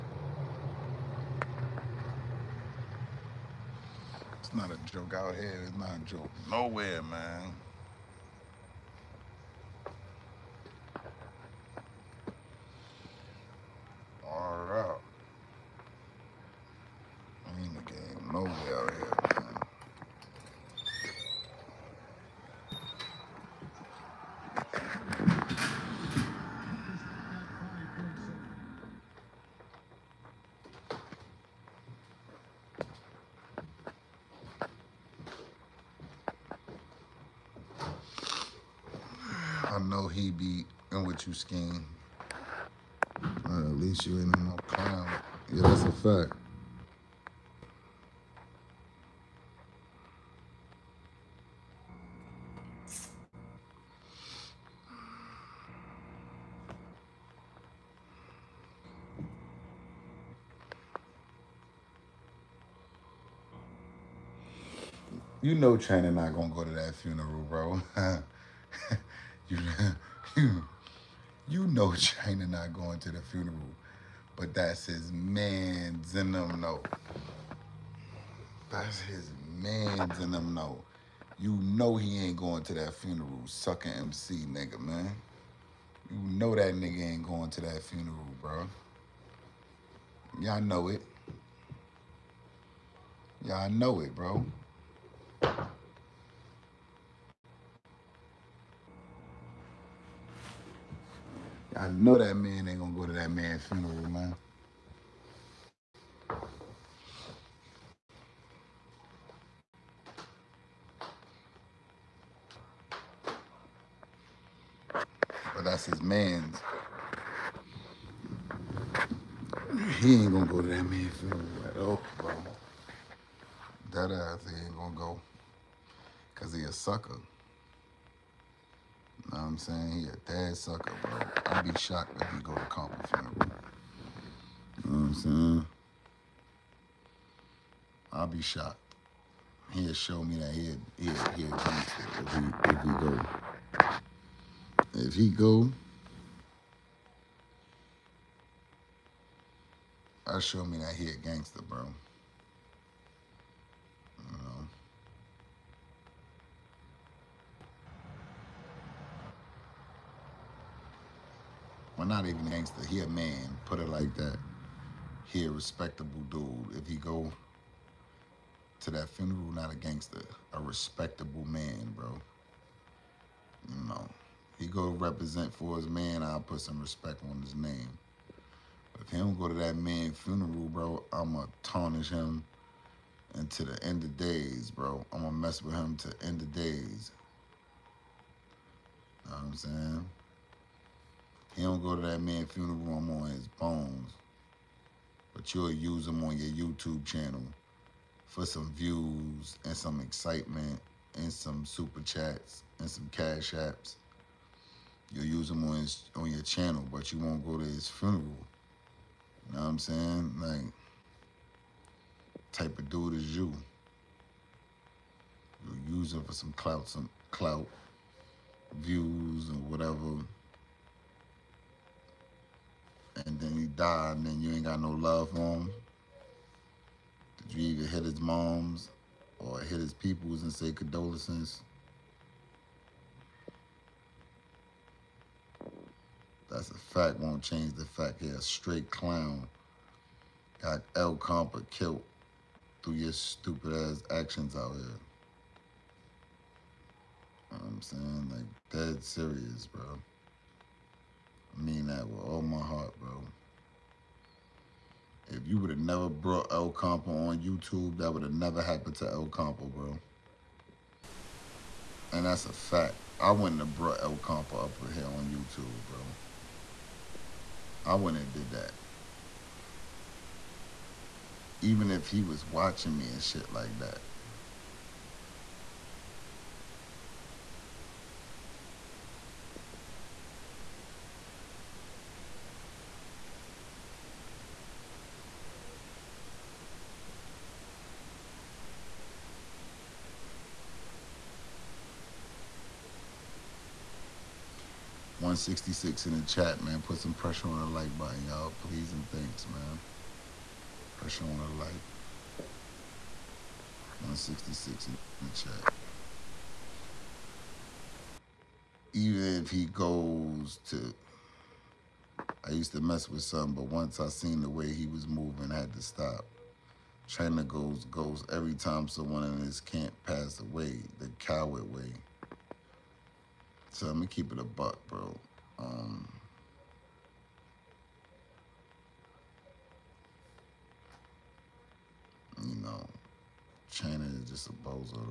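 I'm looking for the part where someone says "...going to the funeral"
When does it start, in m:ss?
1:12.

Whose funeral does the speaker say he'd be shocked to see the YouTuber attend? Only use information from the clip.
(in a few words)
Compton.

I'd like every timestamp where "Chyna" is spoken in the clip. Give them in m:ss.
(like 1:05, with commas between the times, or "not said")
1:05, 1:11, 5:17, 5:33.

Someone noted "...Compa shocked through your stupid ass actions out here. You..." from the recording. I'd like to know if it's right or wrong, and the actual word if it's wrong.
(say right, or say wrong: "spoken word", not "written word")
wrong: "killed", not "shocked".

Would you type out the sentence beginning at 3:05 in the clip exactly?
I'm gonna mess with him to end of days.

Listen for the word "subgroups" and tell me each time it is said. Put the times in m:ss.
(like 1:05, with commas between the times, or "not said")
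not said.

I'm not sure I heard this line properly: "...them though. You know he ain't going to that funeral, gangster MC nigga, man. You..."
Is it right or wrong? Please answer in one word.
wrong.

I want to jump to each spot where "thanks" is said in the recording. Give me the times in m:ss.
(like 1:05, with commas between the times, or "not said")
4:59.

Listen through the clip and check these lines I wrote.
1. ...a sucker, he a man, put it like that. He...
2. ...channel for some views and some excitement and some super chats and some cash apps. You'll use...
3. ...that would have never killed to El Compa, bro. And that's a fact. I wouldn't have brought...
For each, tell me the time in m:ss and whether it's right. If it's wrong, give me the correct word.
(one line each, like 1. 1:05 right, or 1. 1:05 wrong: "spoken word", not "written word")
1. 2:42 wrong: "gangster", not "sucker"
2. 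3:17 right
3. 4:17 wrong: "happened", not "killed".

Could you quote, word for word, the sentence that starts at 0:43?
at least you ain't no clown.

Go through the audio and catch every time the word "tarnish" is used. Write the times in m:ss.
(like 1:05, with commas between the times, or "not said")
3:01.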